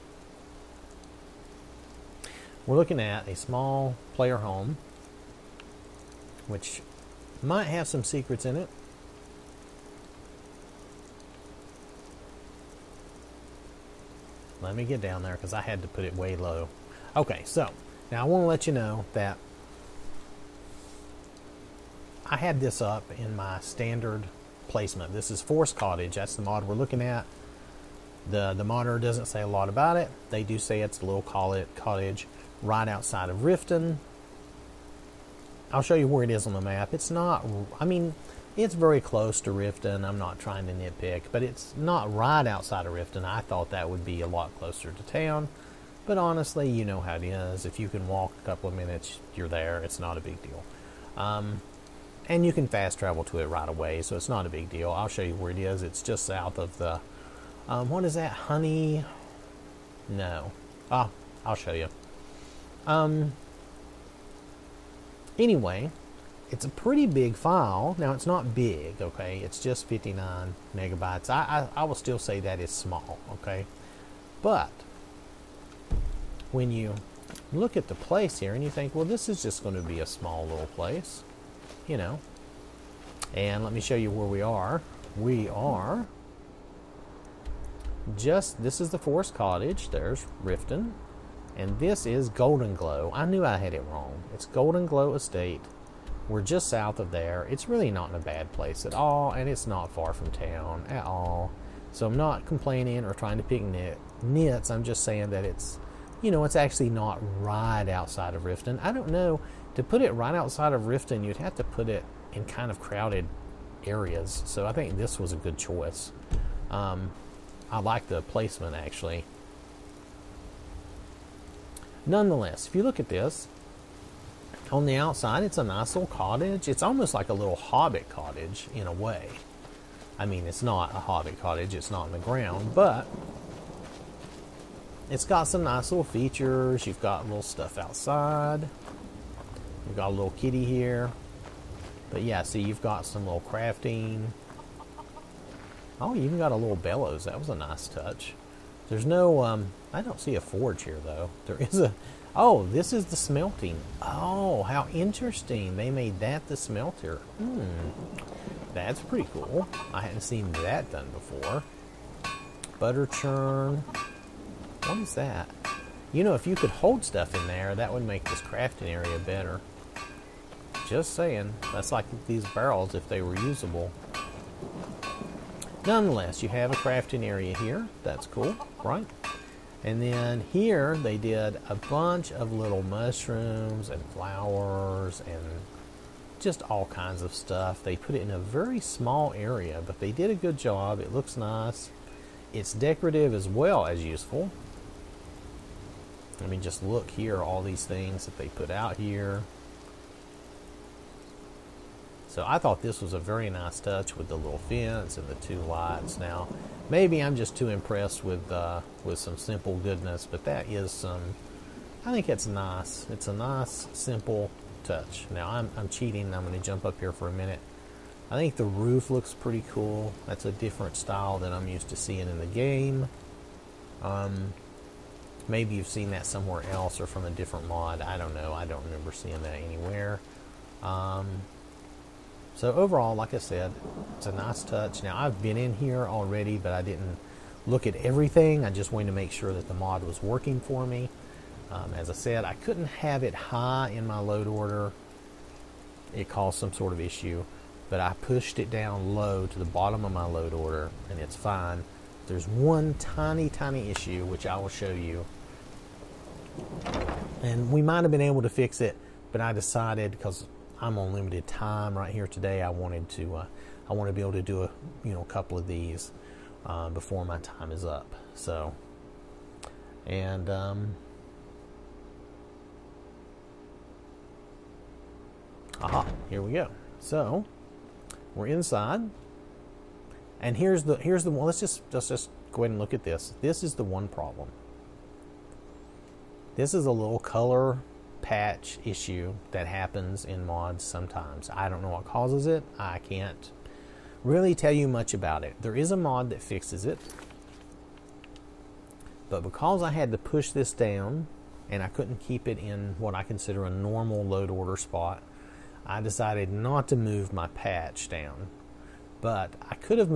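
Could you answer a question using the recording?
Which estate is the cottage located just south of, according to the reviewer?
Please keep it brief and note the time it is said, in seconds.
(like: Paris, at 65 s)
Golden Glow Estate, at 94 s.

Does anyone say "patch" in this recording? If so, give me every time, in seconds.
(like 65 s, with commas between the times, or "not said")
288 s, 307 s.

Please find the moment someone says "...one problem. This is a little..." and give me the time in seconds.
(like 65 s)
283 s.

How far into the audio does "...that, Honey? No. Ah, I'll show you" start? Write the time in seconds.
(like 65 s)
58 s.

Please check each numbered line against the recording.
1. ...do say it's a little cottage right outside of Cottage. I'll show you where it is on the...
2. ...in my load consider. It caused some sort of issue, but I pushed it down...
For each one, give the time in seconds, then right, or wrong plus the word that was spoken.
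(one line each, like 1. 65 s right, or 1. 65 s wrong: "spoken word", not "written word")
1. 30 s wrong: "Riften", not "Cottage"
2. 243 s wrong: "order", not "consider".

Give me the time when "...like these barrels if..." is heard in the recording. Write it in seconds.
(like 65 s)
171 s.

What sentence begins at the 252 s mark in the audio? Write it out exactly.
There's one tiny, tiny issue, which I will show you.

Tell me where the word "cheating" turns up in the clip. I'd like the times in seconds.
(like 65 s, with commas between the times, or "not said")
215 s.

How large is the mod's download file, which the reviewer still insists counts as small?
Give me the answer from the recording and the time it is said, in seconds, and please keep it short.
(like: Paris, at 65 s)
59 megabytes, at 69 s.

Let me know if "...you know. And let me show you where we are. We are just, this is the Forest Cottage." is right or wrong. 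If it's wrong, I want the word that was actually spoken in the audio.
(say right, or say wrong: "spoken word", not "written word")
right.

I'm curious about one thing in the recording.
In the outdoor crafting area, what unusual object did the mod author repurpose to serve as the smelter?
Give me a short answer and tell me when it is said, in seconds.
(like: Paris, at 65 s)
bellows, at 146 s.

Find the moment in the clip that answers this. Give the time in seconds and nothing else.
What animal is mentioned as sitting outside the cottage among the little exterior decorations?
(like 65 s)
140 s.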